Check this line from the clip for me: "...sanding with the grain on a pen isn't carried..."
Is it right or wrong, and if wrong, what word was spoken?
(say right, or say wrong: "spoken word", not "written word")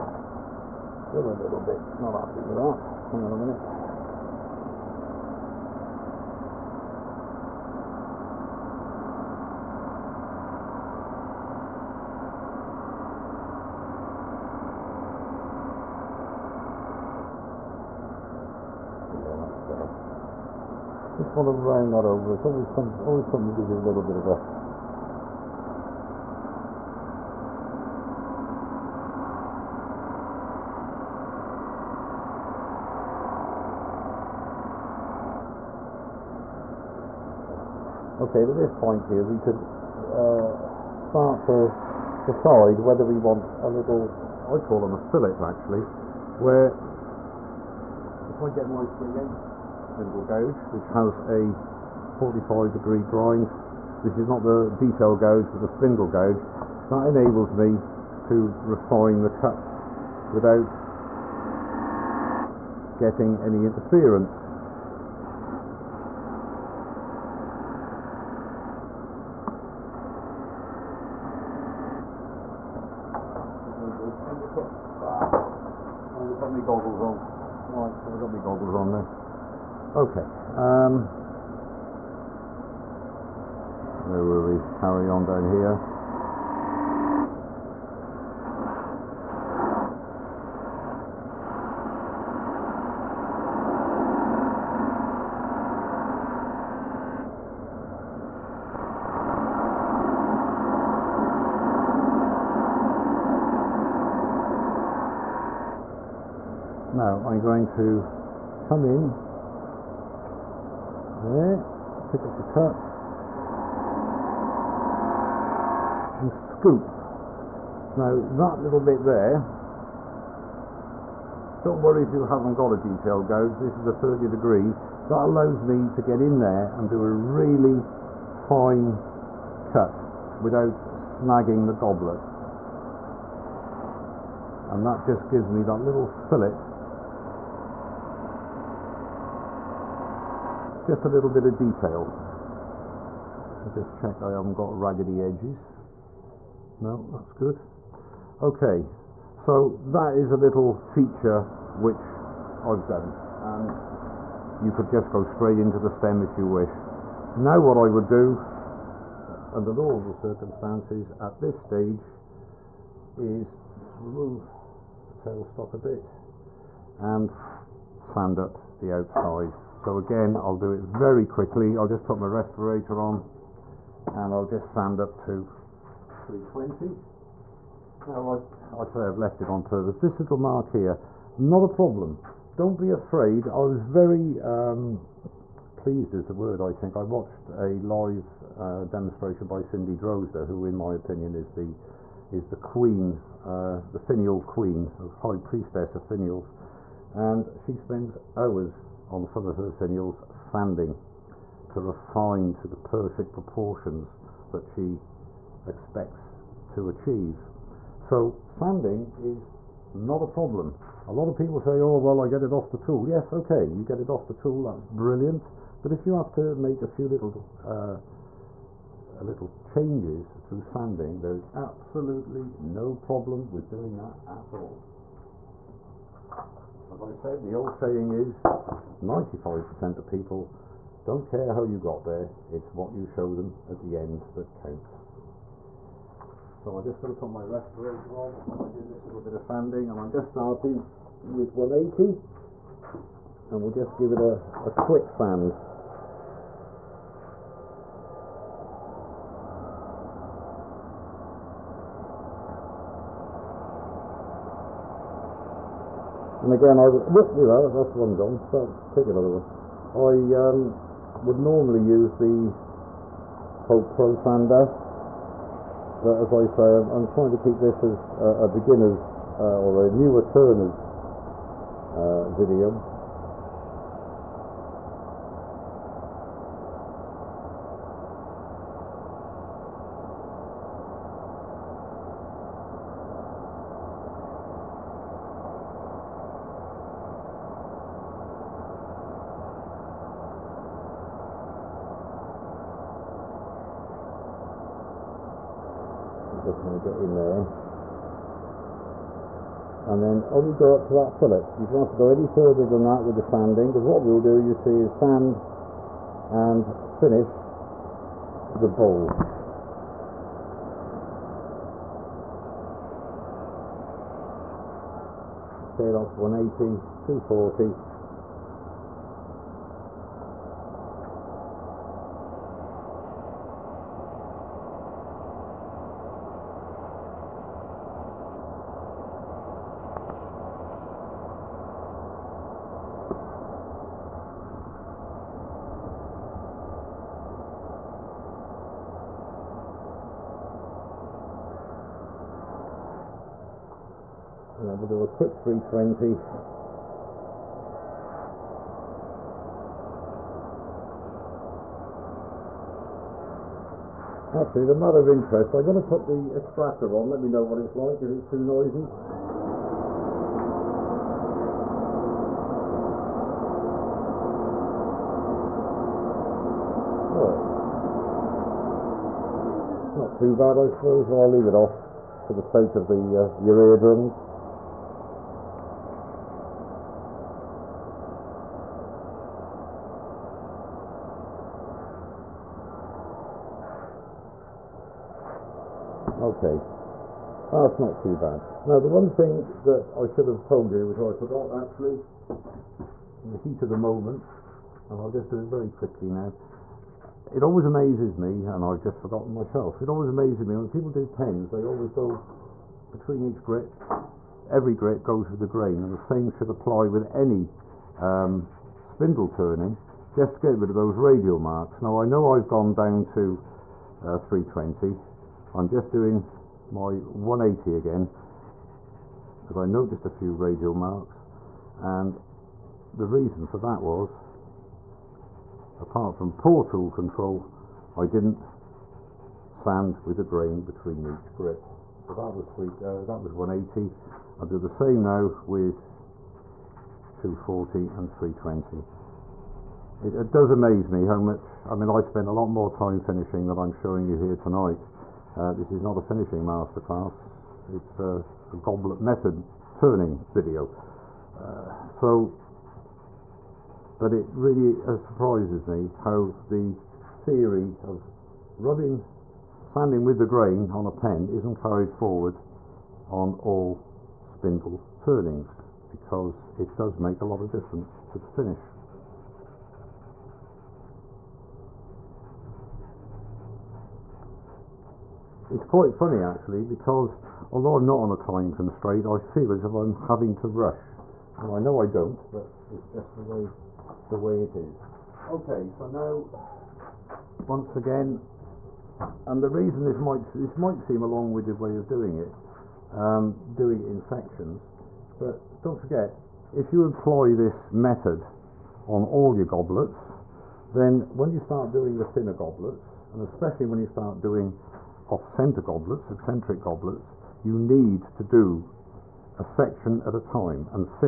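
right.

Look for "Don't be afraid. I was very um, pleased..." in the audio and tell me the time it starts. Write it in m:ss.
3:02.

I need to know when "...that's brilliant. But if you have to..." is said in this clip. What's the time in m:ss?
3:34.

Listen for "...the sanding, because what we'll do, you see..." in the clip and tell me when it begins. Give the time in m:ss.
5:03.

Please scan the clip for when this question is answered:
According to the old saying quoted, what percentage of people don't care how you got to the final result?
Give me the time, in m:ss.
3:49.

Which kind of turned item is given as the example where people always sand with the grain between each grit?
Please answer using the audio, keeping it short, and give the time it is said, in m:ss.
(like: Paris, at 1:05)
pens, at 6:41.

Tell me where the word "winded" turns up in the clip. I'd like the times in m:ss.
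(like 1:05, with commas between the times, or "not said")
8:11.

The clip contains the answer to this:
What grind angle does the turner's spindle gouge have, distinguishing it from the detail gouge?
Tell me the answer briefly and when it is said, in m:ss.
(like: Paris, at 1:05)
45 degrees, at 0:52.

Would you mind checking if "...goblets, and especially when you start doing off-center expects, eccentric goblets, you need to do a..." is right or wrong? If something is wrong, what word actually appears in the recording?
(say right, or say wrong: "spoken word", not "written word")
wrong: "goblets", not "expects".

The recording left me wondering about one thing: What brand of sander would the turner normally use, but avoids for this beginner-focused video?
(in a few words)
Holt Pro.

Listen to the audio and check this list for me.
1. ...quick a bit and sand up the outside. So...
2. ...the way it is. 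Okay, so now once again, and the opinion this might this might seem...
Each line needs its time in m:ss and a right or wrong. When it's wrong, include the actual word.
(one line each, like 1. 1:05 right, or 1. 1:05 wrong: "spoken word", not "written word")
1. 2:45 wrong: "tailstock", not "quick"
2. 8:04 wrong: "reason", not "opinion".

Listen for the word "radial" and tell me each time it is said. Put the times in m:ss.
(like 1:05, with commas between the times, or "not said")
6:50, 7:00.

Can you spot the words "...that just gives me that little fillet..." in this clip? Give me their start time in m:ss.
2:14.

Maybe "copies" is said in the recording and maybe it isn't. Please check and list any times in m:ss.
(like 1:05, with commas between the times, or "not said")
not said.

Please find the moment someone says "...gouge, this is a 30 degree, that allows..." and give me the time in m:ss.
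2:03.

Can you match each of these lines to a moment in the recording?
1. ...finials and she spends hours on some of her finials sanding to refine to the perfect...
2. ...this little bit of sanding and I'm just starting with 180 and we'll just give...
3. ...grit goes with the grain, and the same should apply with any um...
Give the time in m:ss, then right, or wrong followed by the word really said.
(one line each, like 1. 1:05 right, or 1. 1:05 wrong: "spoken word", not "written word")
1. 3:16 right
2. 3:58 right
3. 6:44 right.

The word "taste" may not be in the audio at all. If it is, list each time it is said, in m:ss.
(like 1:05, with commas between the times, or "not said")
not said.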